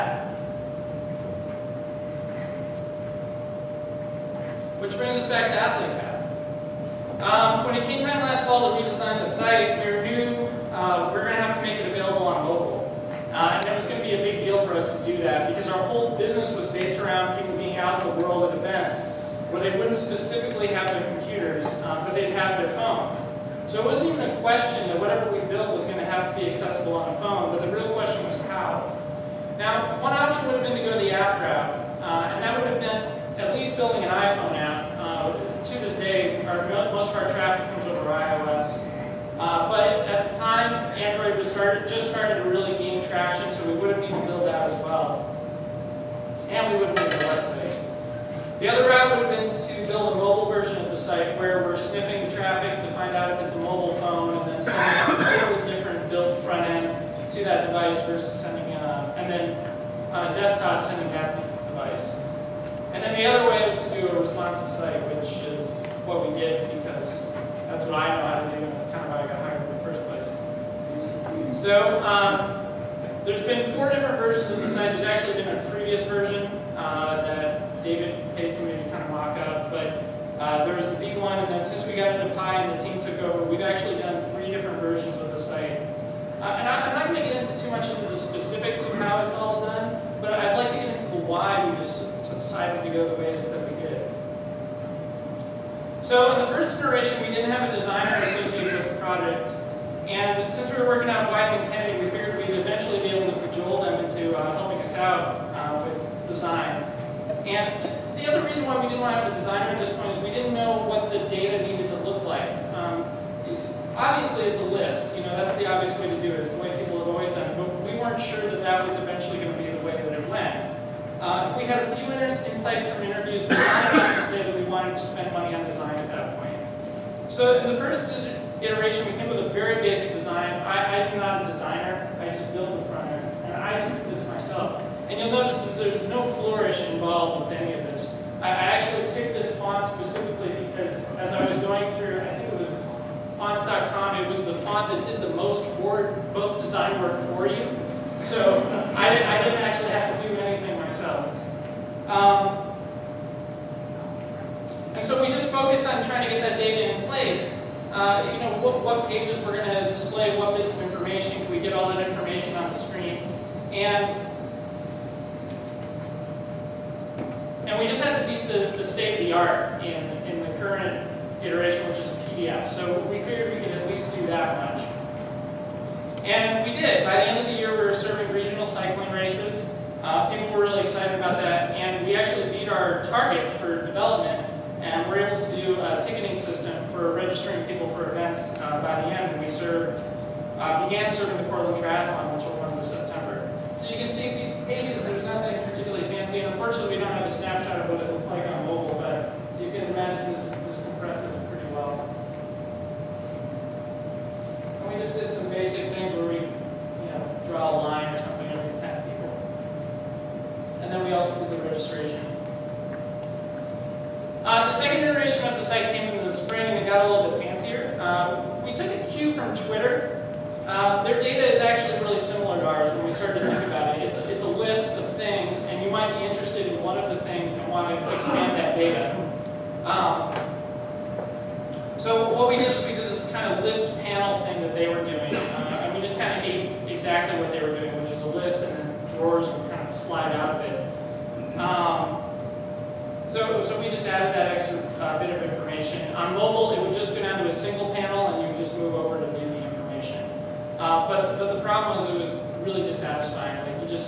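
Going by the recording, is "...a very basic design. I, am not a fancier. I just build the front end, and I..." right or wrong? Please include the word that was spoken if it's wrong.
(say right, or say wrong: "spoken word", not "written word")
wrong: "designer", not "fancier".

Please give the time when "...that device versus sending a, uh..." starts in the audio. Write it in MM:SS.
00:57.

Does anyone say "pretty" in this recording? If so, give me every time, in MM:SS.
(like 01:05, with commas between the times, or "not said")
03:21.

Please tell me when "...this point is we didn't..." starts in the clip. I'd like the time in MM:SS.
01:49.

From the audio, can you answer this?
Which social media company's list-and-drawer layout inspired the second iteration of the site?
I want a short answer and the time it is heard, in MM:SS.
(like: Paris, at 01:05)
Twitter, at 03:39.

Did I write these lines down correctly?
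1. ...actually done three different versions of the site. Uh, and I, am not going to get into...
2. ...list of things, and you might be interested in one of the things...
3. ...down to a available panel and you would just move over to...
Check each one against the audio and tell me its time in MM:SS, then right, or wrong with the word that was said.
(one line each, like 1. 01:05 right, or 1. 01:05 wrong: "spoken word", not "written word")
1. 01:23 right
2. 03:44 right
3. 04:07 wrong: "single", not "available".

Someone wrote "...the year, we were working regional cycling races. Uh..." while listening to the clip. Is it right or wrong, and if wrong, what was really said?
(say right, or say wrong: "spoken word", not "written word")
wrong: "serving", not "working".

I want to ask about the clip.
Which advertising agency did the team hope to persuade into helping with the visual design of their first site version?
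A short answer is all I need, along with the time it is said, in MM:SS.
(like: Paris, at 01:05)
Wieden and Kennedy, at 01:41.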